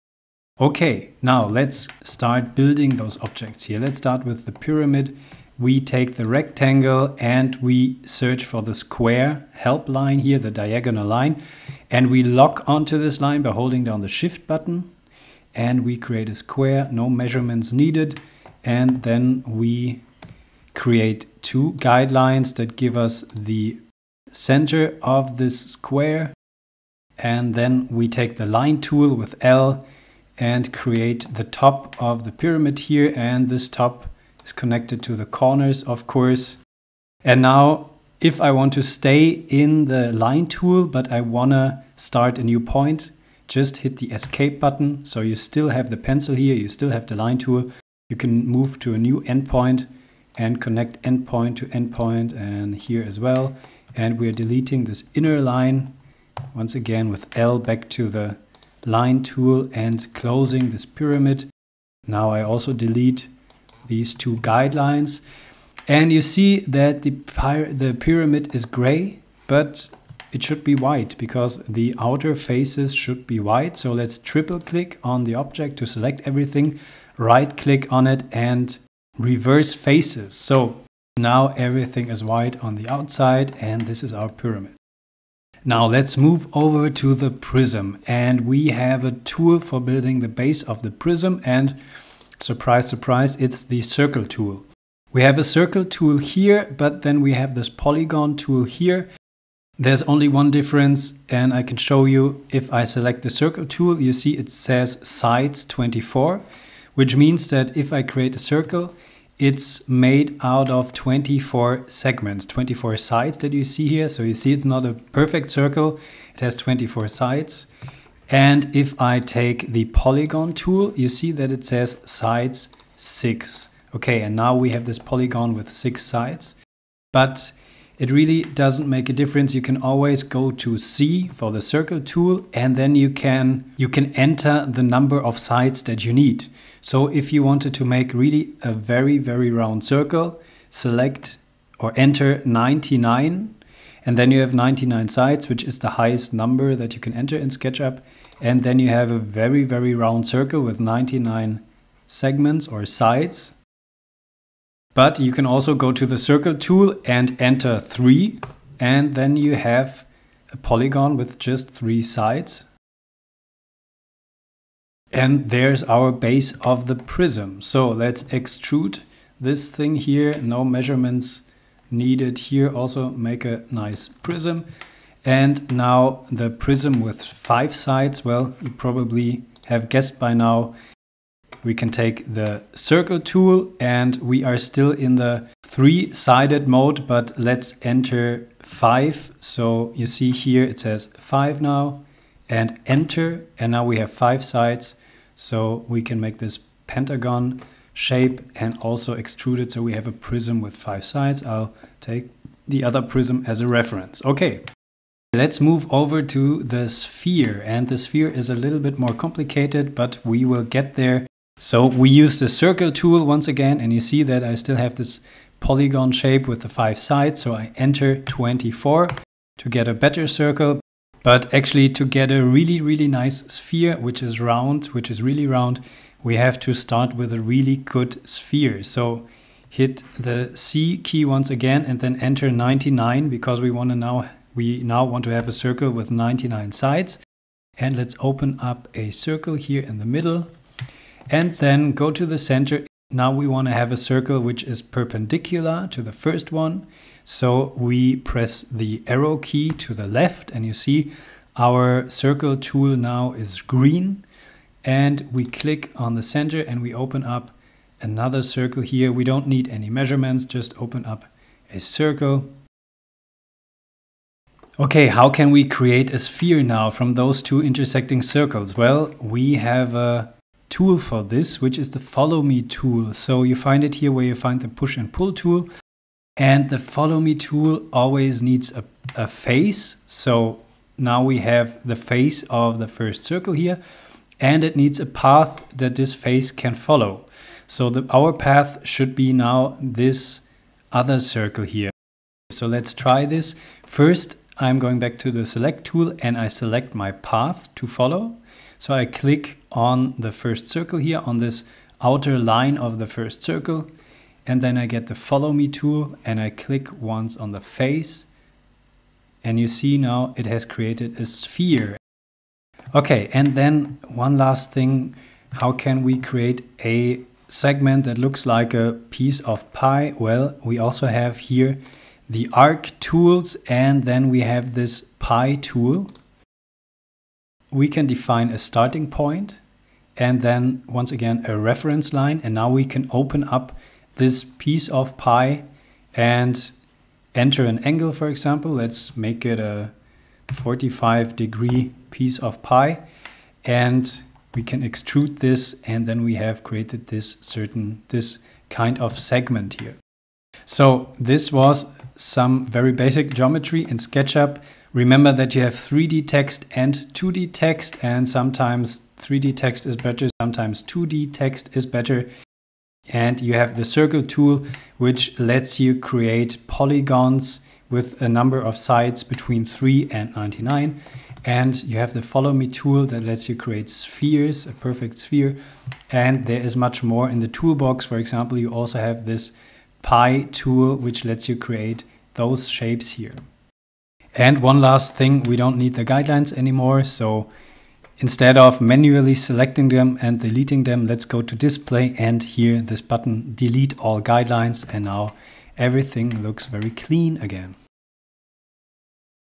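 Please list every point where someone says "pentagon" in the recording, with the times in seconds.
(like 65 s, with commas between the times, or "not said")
196 s.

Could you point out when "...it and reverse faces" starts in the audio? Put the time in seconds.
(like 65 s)
78 s.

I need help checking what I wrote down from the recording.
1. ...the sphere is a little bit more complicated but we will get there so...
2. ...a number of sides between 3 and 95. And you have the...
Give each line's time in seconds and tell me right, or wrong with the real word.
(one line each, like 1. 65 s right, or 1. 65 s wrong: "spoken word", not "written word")
1. 207 s right
2. 368 s wrong: "99", not "95".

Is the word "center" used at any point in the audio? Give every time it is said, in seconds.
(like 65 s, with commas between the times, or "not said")
24 s, 242 s, 256 s.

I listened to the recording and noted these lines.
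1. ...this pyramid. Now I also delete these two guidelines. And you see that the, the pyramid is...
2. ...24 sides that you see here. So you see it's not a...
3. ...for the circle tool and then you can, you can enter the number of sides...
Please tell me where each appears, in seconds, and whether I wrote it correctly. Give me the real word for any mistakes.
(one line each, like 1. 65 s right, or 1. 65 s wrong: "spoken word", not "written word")
1. 60 s right
2. 112 s right
3. 131 s right.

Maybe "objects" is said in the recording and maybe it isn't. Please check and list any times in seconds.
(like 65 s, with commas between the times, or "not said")
3 s, 75 s.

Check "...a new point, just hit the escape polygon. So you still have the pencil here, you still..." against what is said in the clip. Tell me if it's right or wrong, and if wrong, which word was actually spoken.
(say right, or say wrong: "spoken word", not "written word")
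wrong: "button", not "polygon".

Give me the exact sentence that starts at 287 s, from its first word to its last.
So the, our path should be now this other circle here.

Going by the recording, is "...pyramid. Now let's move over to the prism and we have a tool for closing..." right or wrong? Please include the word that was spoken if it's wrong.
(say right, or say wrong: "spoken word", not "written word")
wrong: "building", not "closing".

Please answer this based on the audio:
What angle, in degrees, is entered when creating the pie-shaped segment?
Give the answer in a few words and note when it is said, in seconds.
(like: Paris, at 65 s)
45, at 340 s.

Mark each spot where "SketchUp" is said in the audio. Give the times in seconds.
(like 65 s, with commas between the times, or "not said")
147 s, 353 s.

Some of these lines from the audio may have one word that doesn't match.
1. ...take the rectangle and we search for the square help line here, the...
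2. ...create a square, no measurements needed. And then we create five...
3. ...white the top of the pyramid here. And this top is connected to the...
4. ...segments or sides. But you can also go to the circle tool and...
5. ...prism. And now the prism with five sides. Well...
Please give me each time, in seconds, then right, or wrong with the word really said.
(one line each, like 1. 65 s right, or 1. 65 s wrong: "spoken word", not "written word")
1. 5 s right
2. 15 s wrong: "two", not "five"
3. 30 s wrong: "create", not "white"
4. 152 s right
5. 174 s right.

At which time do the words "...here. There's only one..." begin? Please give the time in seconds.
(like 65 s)
98 s.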